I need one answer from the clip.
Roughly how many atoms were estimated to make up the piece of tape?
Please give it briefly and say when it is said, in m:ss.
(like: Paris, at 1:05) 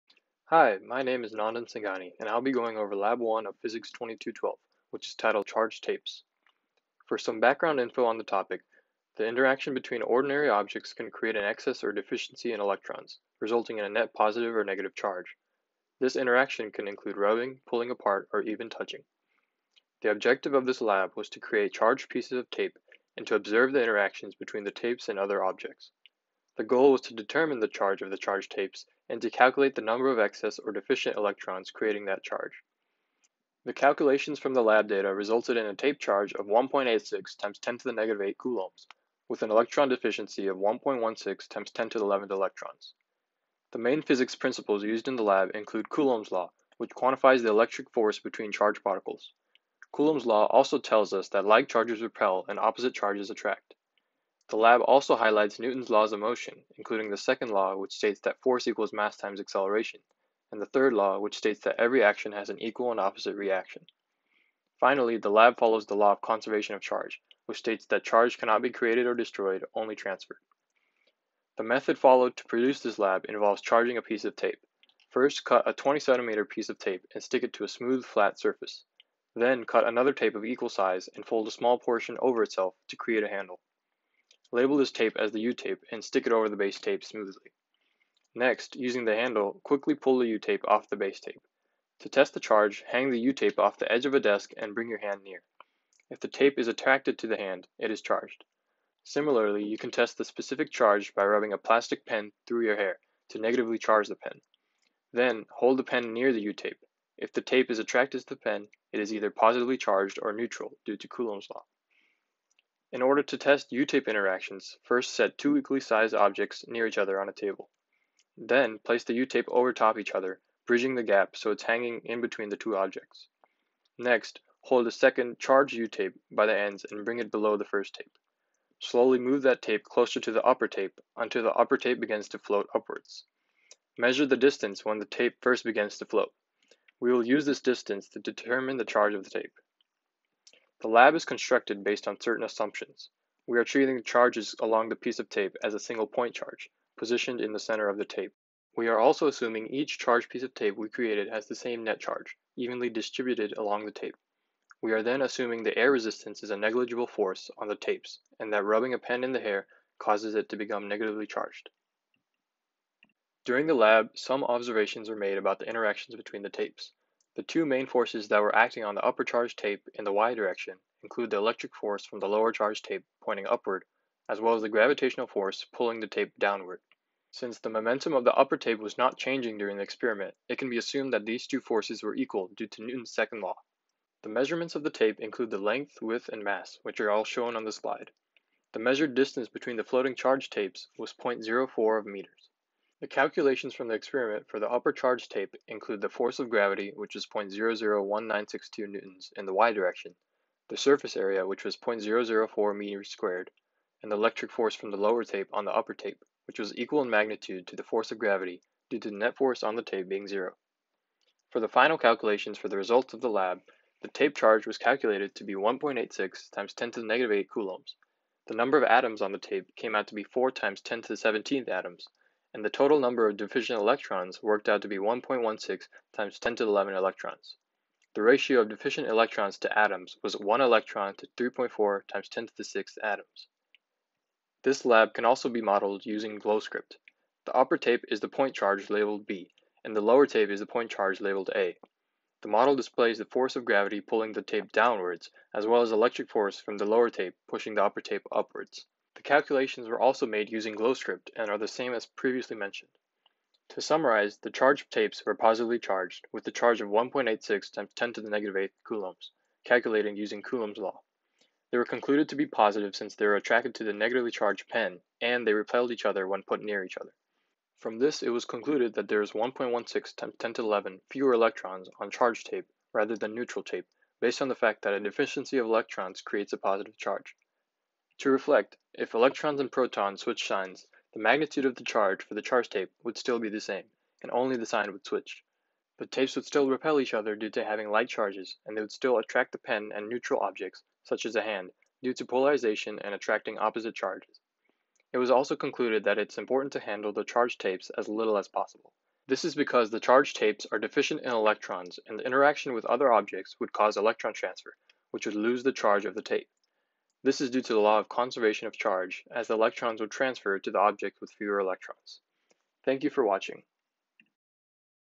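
4 x 10^17, at 3:40.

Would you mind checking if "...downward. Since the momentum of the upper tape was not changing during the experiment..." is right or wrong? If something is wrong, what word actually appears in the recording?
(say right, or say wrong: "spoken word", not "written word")
right.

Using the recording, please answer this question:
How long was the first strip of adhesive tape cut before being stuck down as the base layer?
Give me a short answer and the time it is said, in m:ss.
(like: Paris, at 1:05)
20 centimeters, at 1:15.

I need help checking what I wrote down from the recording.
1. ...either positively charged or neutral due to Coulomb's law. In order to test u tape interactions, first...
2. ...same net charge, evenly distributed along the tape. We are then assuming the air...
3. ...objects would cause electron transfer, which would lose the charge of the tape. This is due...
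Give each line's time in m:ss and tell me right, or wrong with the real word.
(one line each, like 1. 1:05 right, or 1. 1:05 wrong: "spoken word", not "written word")
1. 1:49 right
2. 2:31 right
3. 5:03 right.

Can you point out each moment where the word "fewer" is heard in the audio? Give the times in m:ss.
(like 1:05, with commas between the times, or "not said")
4:31, 5:11.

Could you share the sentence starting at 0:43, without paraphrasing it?
The main physics principles used in the lab include Coulomb's law, which quantifies the electric force between charged particles.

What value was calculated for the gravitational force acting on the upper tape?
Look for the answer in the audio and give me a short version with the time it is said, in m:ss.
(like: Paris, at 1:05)
0.001962 newtons, at 3:17.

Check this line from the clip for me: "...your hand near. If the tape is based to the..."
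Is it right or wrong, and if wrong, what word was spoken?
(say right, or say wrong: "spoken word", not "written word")
wrong: "attracted", not "based".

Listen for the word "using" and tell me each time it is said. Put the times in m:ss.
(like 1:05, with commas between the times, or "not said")
1:28, 3:56, 4:10, 4:20.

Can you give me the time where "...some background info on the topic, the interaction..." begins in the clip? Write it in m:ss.
0:07.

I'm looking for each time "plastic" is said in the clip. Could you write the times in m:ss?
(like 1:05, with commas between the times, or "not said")
1:41.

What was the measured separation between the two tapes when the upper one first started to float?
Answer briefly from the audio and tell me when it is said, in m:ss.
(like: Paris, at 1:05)
0.04 meters, at 3:11.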